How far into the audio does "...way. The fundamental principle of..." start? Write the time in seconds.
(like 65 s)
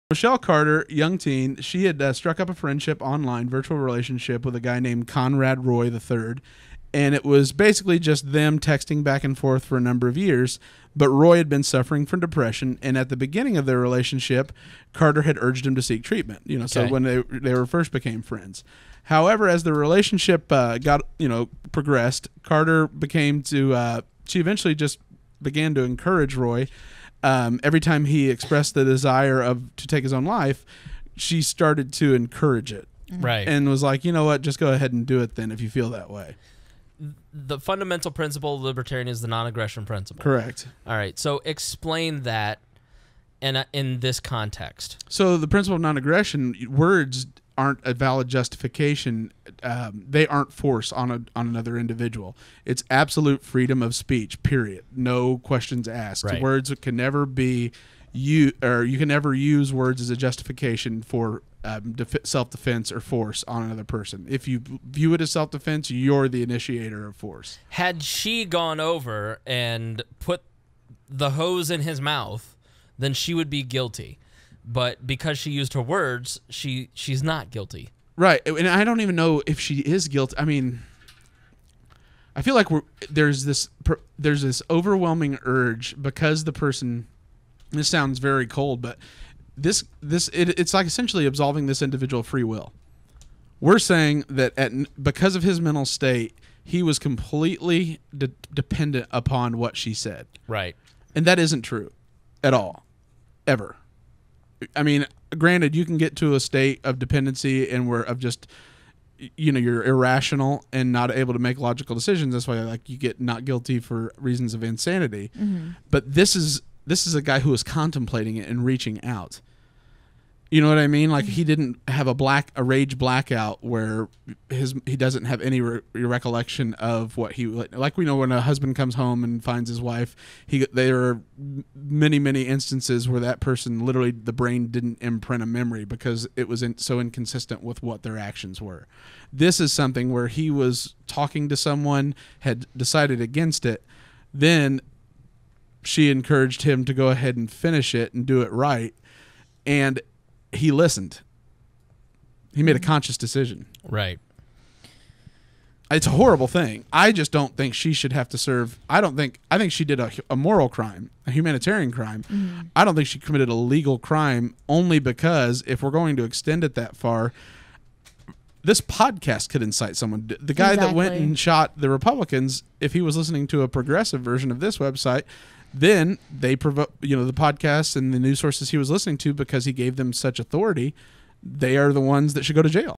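36 s.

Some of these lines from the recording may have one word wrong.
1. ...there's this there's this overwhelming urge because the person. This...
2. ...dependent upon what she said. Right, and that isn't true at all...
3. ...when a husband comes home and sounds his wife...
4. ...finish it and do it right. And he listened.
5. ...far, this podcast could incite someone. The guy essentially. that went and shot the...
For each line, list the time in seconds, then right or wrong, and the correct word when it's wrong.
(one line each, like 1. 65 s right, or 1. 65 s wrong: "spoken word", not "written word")
1. 83 s right
2. 98 s right
3. 128 s wrong: "finds", not "sounds"
4. 147 s right
5. 166 s wrong: "exactly", not "essentially".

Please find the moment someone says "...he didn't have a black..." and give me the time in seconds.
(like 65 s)
121 s.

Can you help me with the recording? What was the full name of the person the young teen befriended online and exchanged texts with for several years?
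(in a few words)
Conrad Roy III.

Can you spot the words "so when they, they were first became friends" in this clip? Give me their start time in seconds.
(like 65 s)
16 s.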